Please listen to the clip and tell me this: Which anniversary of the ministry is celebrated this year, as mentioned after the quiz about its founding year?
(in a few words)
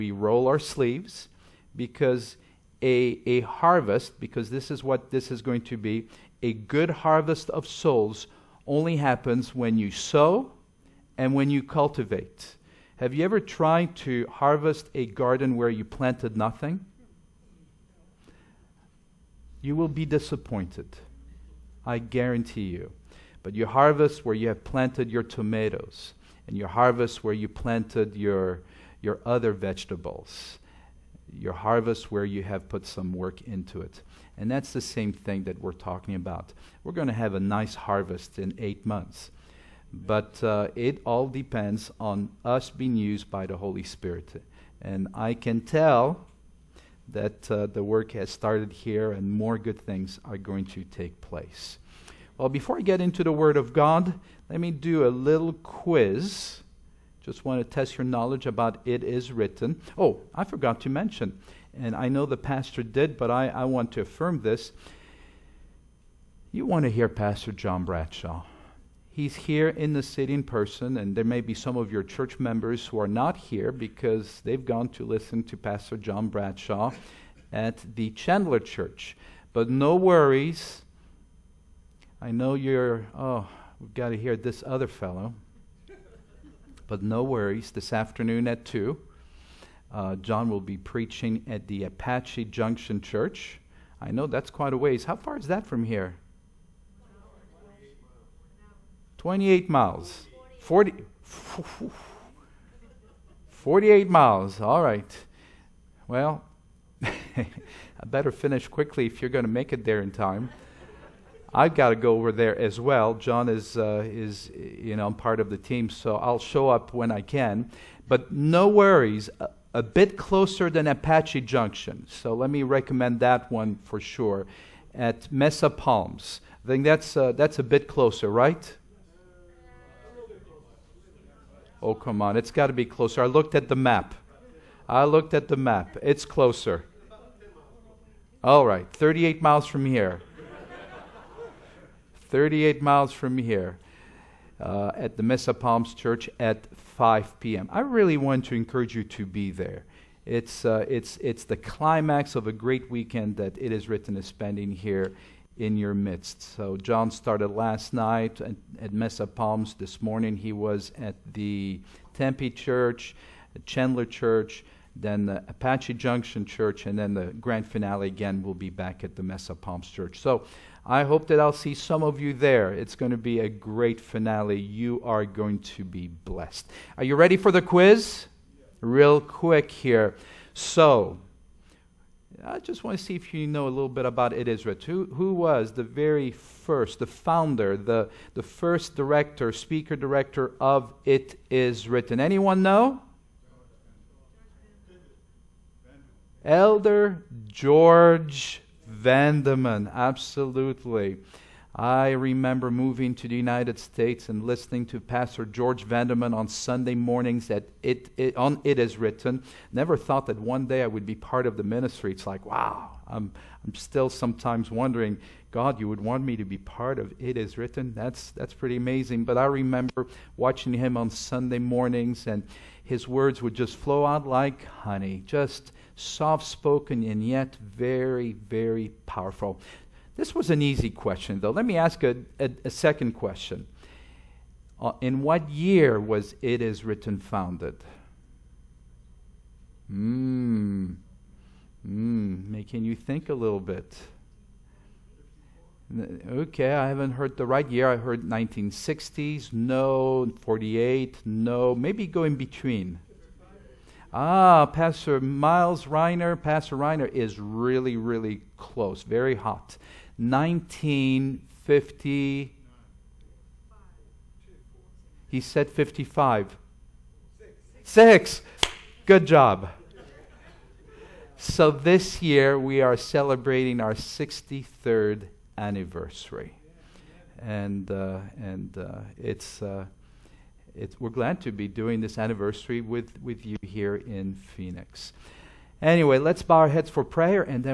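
63rd.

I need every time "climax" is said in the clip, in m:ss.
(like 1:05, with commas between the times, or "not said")
2:31.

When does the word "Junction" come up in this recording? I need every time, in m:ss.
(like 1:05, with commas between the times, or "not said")
1:32, 2:01, 2:45.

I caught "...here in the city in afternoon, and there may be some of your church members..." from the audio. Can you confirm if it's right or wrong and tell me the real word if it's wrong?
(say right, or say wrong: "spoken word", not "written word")
wrong: "person", not "afternoon".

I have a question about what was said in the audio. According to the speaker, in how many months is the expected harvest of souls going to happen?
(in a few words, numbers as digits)
8.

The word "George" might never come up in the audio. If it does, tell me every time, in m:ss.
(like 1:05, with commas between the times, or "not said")
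3:17, 3:25.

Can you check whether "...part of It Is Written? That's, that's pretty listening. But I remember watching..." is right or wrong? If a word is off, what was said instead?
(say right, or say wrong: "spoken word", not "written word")
wrong: "amazing", not "listening".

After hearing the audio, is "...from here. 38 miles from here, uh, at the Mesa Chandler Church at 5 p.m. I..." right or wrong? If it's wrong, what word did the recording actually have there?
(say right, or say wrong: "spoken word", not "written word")
wrong: "Palms", not "Chandler".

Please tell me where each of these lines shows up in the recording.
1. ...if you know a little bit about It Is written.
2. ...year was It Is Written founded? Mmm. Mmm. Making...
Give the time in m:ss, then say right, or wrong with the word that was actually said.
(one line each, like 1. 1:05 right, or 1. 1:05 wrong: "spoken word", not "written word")
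1. 3:03 right
2. 3:55 right.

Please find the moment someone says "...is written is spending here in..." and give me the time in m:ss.
2:33.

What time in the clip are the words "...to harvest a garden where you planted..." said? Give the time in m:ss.
0:13.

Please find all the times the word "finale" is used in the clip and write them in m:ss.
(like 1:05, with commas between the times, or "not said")
2:47, 2:53.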